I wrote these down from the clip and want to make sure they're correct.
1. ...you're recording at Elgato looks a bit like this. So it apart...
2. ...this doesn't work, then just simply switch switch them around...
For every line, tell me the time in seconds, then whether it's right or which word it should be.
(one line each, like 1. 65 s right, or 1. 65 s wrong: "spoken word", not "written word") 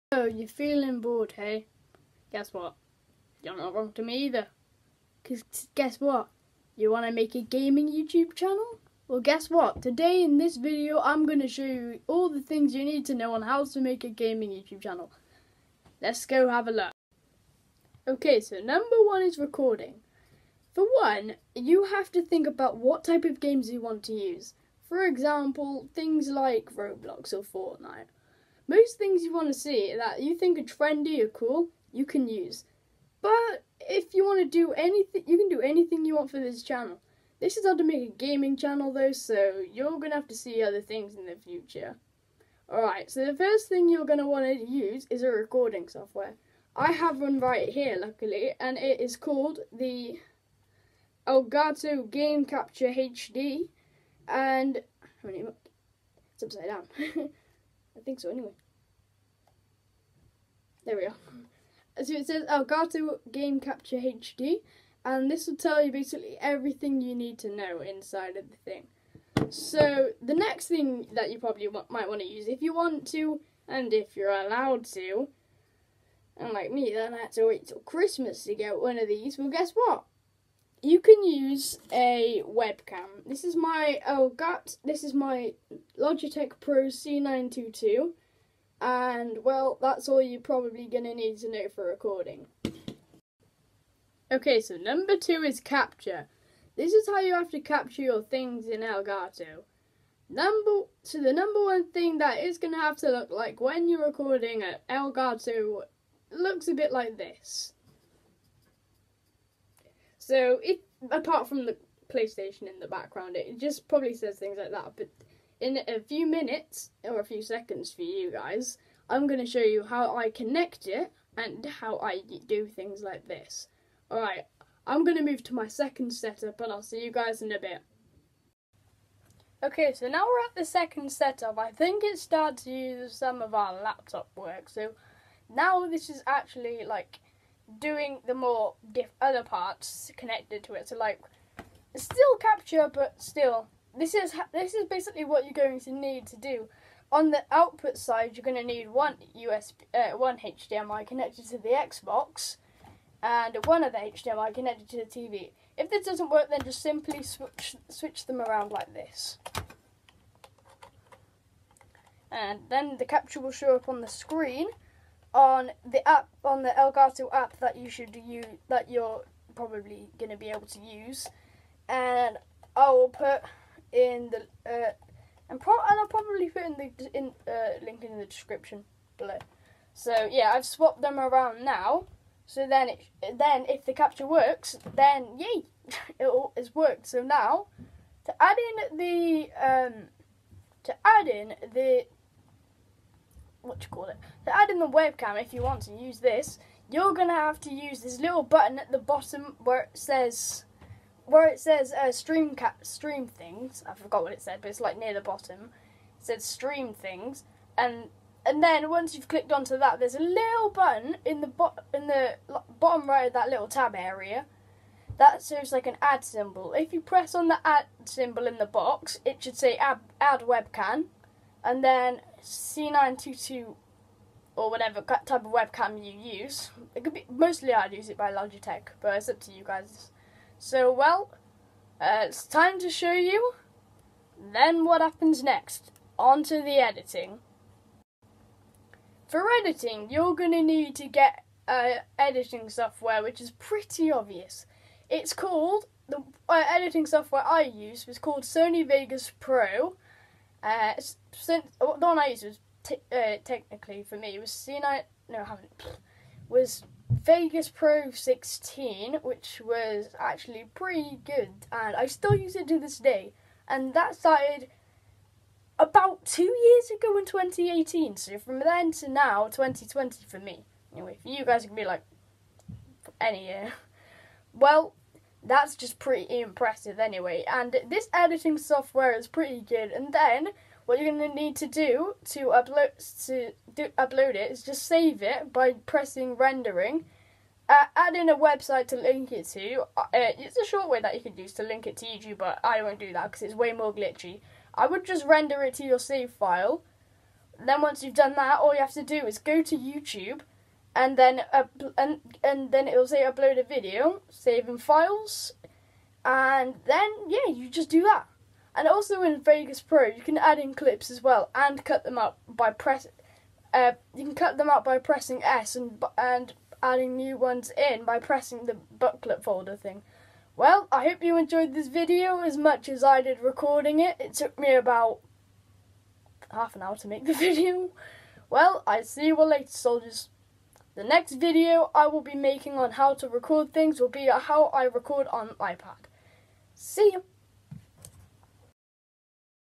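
1. 103 s right
2. 155 s right.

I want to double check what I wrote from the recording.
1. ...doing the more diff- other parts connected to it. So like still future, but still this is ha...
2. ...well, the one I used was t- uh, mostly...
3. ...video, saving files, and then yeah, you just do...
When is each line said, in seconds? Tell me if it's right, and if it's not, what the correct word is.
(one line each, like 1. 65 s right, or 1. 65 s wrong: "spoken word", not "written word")
1. 137 s wrong: "capture", not "future"
2. 251 s wrong: "technically", not "mostly"
3. 303 s right.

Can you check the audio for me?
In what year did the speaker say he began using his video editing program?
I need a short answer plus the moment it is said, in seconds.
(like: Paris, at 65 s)
2018, at 267 s.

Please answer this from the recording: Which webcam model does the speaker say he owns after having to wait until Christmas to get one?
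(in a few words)
Logitech Pro C922.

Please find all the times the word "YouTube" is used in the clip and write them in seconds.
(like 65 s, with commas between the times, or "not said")
7 s, 14 s, 292 s, 299 s.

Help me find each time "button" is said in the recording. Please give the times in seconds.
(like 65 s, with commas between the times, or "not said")
198 s, 210 s.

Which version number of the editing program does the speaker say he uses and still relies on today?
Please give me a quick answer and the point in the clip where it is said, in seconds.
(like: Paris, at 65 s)
16, at 257 s.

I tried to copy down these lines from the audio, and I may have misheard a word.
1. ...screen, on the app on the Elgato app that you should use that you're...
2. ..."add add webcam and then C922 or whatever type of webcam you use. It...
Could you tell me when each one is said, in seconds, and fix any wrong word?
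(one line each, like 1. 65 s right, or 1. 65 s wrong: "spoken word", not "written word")
1. 164 s right
2. 219 s right.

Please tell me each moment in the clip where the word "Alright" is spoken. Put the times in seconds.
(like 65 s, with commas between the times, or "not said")
42 s, 124 s.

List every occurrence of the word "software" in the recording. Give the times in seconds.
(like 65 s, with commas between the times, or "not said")
45 s, 242 s, 247 s, 278 s.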